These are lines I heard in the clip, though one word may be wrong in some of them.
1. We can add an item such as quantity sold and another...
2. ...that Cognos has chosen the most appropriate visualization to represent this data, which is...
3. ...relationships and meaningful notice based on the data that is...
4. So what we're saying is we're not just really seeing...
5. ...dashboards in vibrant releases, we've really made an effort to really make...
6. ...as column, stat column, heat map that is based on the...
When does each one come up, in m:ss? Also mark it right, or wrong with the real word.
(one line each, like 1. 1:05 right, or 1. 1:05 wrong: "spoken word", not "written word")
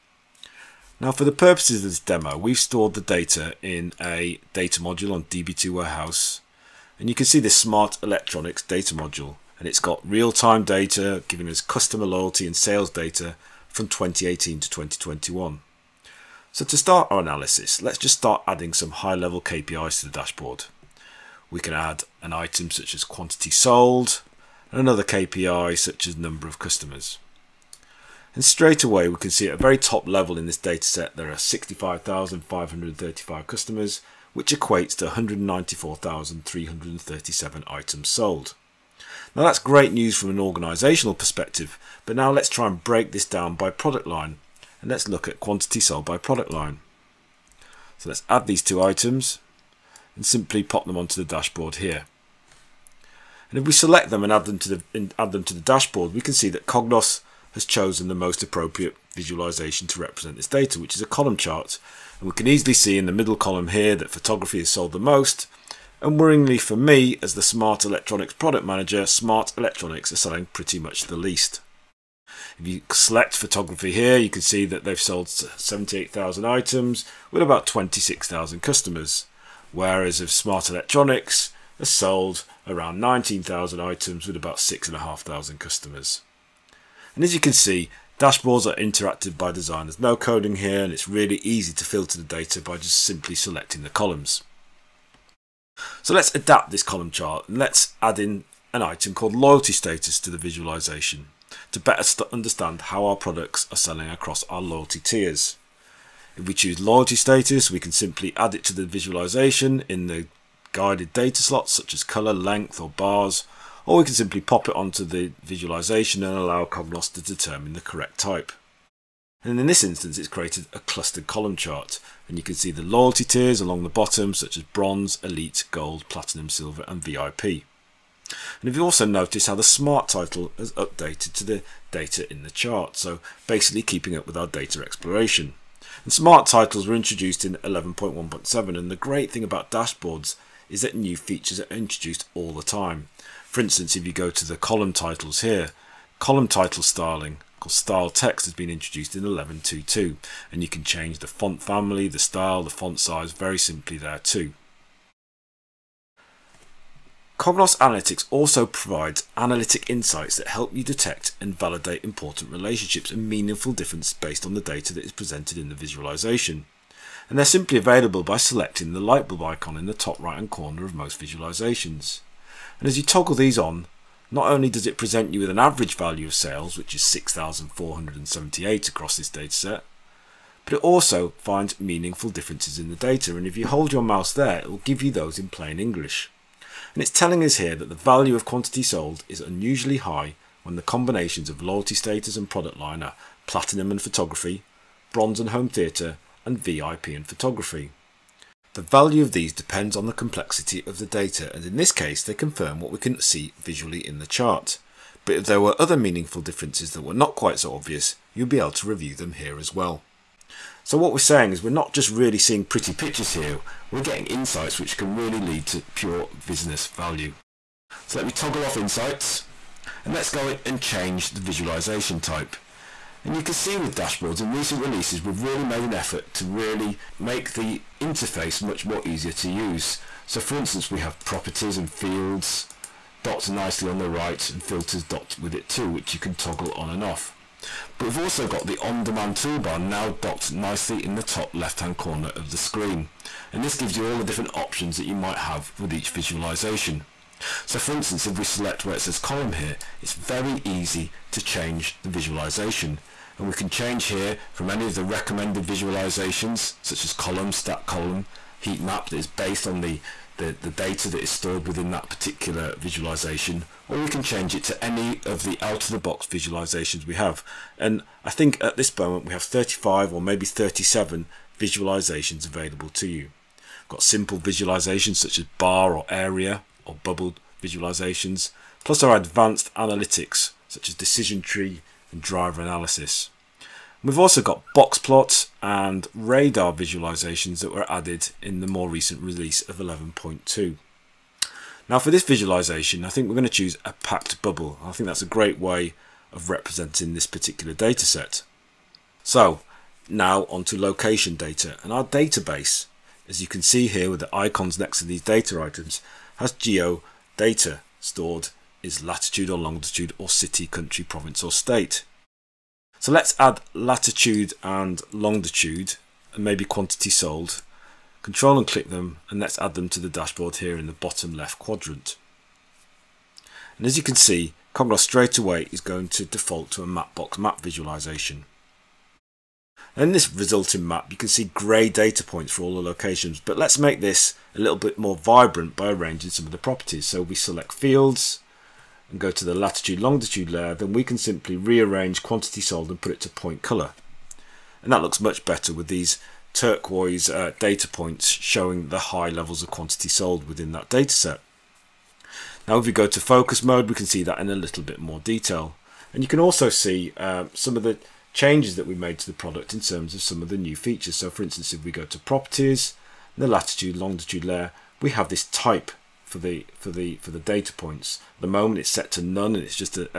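1. 0:21 right
2. 0:56 right
3. 2:42 wrong: "difference", not "notice"
4. 3:30 right
5. 3:43 wrong: "recent", not "vibrant"
6. 4:17 right.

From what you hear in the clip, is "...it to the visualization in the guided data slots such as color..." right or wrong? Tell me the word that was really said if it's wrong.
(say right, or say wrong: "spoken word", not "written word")
right.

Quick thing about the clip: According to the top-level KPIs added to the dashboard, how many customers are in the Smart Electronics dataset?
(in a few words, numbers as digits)
65,535.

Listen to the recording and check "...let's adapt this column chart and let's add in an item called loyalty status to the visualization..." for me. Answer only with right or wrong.
right.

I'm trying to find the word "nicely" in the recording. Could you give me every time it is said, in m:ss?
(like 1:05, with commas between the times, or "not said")
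3:53, 4:00.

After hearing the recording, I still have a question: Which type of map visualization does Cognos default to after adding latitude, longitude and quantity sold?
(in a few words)
Mapbox map.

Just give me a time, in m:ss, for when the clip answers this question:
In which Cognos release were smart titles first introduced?
2:17.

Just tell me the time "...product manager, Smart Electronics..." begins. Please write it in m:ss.
1:08.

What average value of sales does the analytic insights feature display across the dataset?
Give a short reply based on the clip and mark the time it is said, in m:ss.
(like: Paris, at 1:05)
6,478, at 2:57.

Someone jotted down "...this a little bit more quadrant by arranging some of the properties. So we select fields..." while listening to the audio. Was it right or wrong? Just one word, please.
wrong.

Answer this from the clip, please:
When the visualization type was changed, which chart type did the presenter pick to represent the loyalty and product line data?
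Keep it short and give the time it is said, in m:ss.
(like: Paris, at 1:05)
Packed bubble, at 4:54.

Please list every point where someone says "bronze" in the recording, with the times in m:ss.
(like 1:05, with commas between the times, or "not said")
2:04, 3:15.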